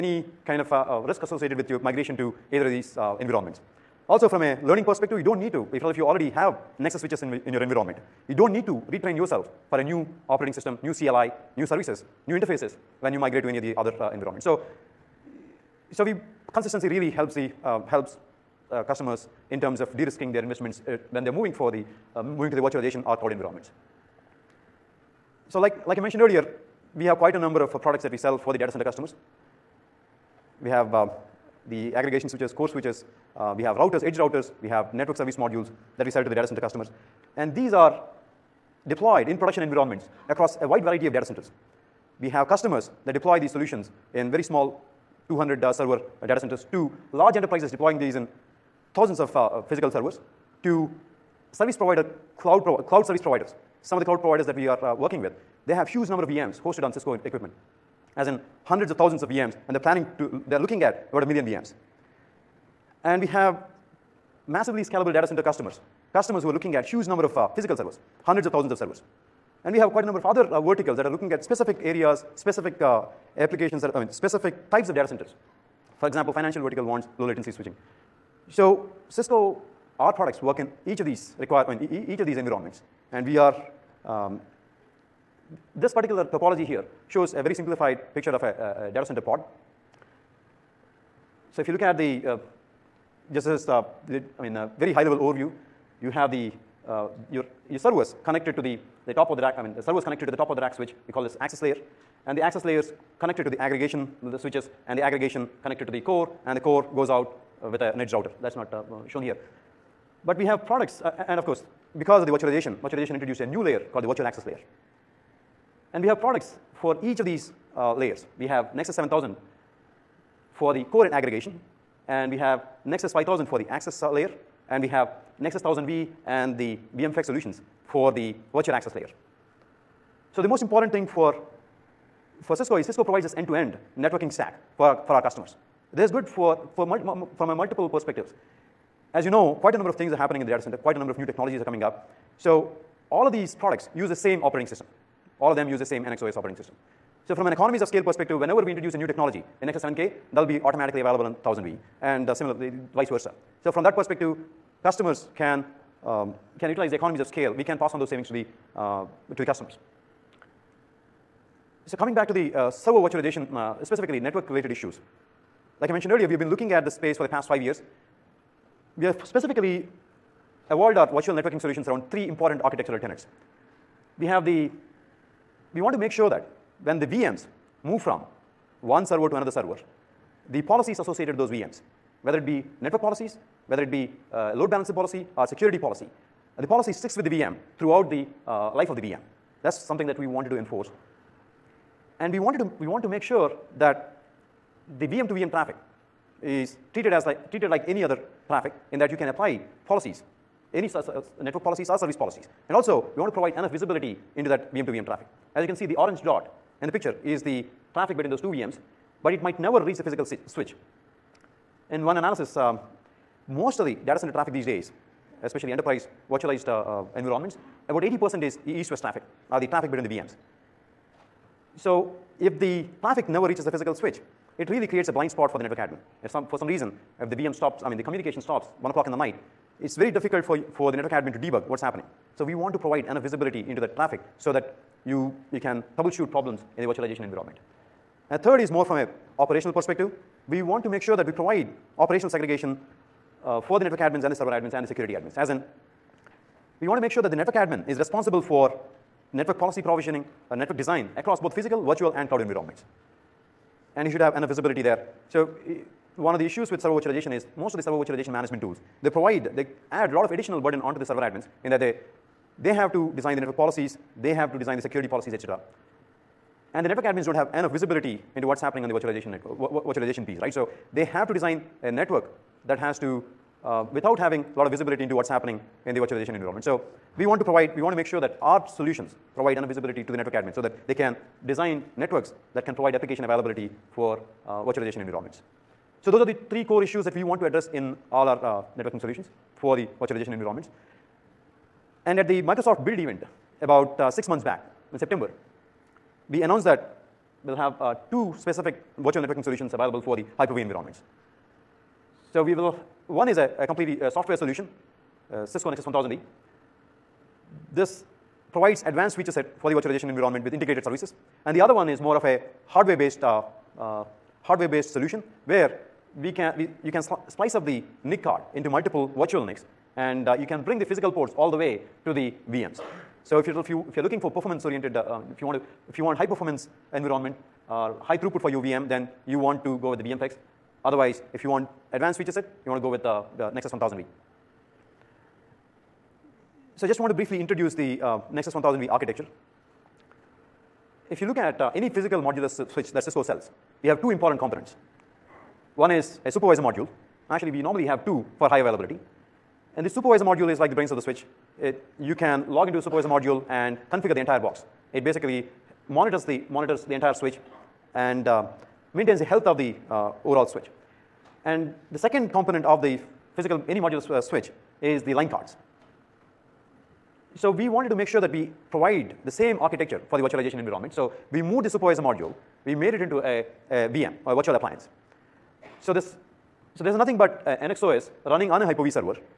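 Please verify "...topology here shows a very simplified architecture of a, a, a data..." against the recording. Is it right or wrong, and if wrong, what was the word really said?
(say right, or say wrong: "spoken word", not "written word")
wrong: "picture", not "architecture".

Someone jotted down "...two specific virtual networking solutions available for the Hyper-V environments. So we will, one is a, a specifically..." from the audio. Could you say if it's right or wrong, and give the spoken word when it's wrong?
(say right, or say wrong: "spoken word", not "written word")
wrong: "completely", not "specifically".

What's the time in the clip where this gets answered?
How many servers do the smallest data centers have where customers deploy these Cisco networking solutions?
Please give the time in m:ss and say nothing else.
0:45.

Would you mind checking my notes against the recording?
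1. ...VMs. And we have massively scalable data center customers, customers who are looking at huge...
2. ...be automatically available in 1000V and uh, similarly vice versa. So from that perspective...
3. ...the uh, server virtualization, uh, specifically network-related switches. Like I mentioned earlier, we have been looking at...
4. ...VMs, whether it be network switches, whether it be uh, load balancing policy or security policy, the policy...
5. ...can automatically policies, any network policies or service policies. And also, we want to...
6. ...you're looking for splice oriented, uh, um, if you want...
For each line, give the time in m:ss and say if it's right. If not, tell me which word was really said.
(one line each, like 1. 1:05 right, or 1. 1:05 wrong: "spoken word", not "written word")
1. 1:01 right
2. 2:30 right
3. 2:42 wrong: "issues", not "switches"
4. 3:01 wrong: "policies", not "switches"
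5. 3:19 wrong: "apply", not "automatically"
6. 5:23 wrong: "performance", not "splice".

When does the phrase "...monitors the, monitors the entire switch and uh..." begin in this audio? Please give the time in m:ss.
5:55.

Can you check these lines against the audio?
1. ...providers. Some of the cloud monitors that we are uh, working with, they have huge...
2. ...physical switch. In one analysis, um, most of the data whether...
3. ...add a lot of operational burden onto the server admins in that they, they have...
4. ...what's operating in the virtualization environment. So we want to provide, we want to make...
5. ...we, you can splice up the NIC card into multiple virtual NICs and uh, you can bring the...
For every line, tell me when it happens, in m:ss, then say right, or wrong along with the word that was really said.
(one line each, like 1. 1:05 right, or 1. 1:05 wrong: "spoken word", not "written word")
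1. 0:53 wrong: "providers", not "monitors"
2. 3:30 wrong: "center", not "whether"
3. 4:19 wrong: "additional", not "operational"
4. 4:35 wrong: "happening", not "operating"
5. 5:16 right.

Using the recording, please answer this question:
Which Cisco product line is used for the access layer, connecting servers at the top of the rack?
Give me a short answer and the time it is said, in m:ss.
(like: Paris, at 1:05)
Nexus 5000, at 2:02.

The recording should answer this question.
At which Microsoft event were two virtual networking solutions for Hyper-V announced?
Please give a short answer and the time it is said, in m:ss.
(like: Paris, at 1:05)
Microsoft Build, at 4:52.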